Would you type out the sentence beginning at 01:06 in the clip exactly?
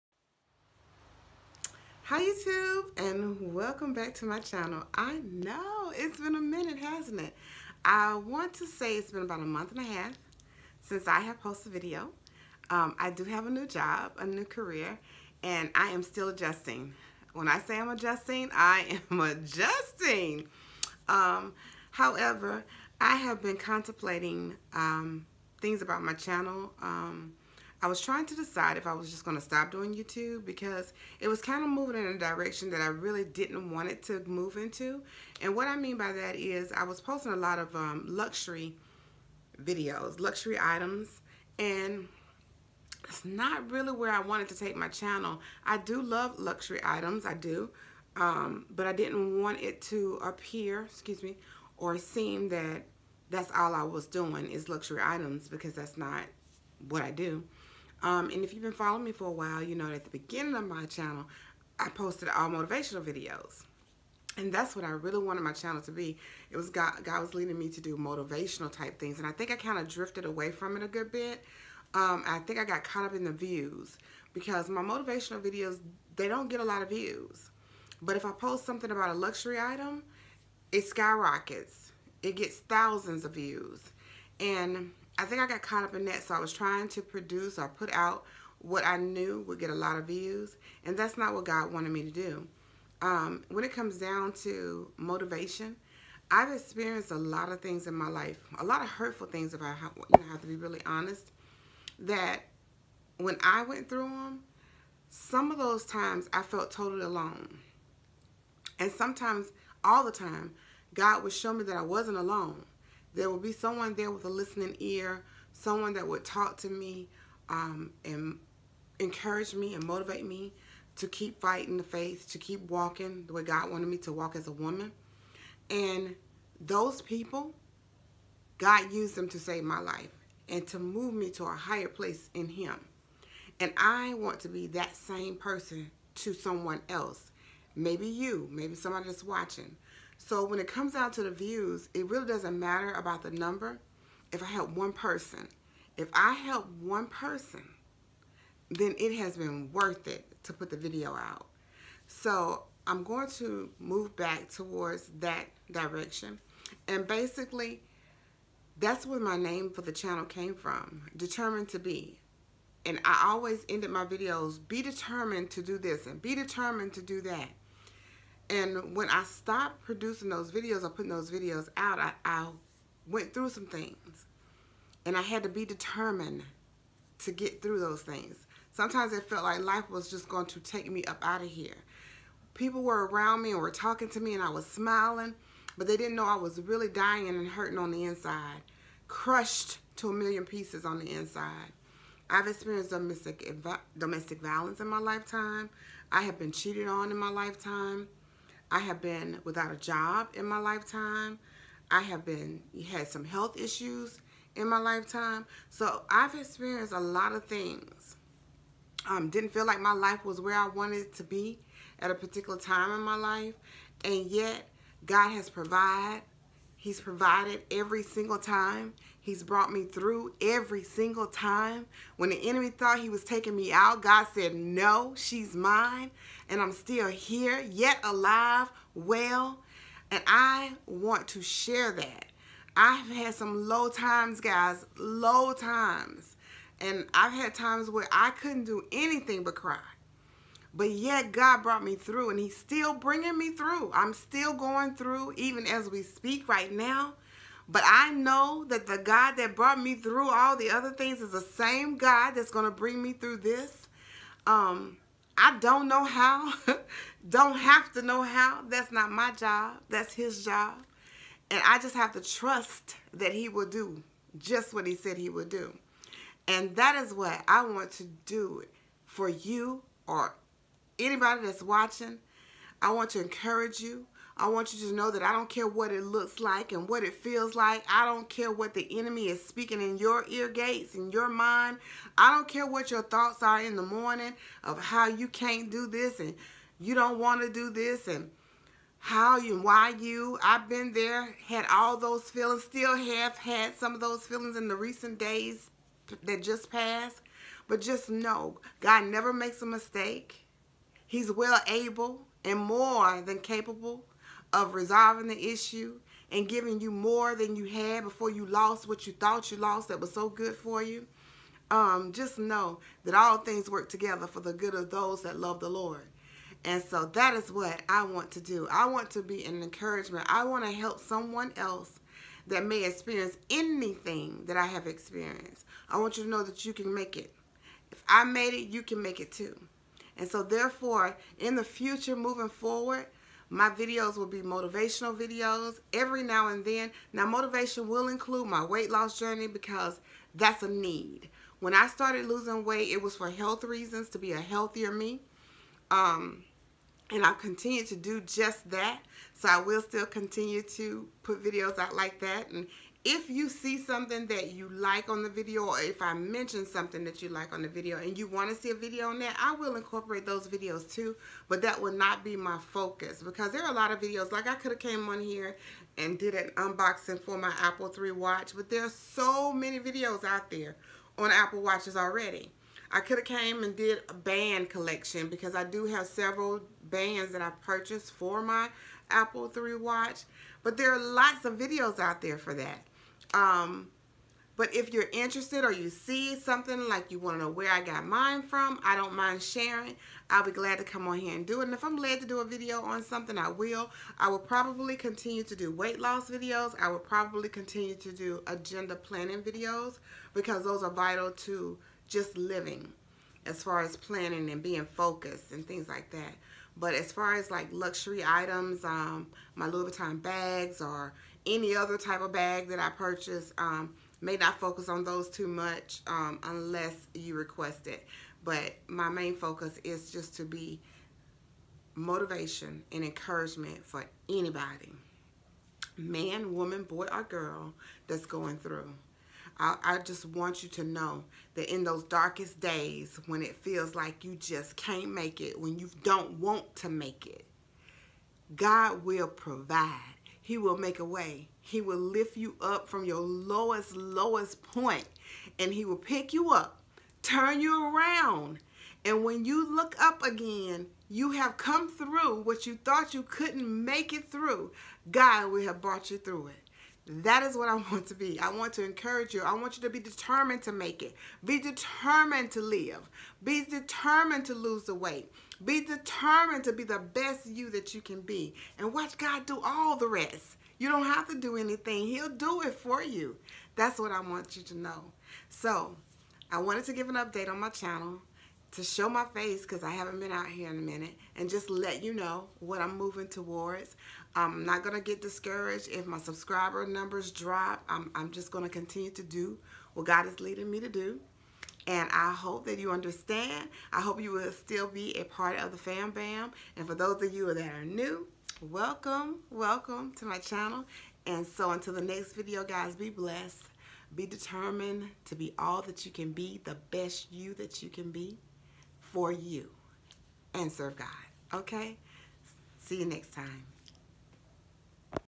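It was God, God was leading me to do motivational type things.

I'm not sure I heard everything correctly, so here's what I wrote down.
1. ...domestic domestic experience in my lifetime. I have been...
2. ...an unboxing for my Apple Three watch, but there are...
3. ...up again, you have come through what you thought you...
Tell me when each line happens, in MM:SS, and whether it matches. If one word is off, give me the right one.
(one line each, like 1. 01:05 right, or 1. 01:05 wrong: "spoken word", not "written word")
1. 03:12 wrong: "violence", not "experience"
2. 06:06 right
3. 07:30 right.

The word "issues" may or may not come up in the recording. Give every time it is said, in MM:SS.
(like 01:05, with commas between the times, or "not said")
03:23, 05:05.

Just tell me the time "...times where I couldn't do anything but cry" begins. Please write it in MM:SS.
03:57.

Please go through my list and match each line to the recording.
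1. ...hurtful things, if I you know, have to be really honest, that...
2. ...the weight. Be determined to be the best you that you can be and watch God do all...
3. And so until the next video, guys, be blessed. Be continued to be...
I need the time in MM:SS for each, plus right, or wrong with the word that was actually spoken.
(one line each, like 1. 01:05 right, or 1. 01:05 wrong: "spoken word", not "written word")
1. 01:38 right
2. 07:44 right
3. 08:21 wrong: "determined", not "continued".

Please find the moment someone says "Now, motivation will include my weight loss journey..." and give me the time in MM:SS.
05:37.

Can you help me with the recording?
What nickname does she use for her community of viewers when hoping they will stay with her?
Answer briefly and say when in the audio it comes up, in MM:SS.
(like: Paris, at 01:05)
Fam Bam, at 08:15.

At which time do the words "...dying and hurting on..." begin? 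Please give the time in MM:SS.
03:06.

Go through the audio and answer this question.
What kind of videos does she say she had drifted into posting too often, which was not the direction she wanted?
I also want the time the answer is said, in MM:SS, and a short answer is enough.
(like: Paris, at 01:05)
luxury videos, at 00:38.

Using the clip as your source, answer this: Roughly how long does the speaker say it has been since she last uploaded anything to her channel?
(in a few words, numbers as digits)
a month and a half.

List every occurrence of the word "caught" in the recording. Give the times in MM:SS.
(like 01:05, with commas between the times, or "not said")
01:12, 01:25.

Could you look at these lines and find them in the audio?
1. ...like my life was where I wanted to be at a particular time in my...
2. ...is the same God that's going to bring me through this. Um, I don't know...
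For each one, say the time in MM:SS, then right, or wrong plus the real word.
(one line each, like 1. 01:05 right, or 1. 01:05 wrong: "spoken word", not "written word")
1. 03:29 right
2. 04:11 right.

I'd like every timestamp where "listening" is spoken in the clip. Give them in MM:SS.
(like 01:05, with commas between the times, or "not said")
01:54.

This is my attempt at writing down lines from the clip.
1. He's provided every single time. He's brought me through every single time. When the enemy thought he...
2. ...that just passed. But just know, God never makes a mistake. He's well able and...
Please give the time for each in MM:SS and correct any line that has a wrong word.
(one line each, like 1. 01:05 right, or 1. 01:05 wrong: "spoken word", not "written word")
1. 03:36 right
2. 04:56 right.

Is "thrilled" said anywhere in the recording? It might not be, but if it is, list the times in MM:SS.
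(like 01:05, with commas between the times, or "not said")
not said.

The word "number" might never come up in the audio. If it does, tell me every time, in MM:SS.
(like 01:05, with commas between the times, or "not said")
02:23, 08:06.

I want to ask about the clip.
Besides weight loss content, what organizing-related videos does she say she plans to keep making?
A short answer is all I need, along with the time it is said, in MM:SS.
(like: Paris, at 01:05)
agenda planning videos, at 06:38.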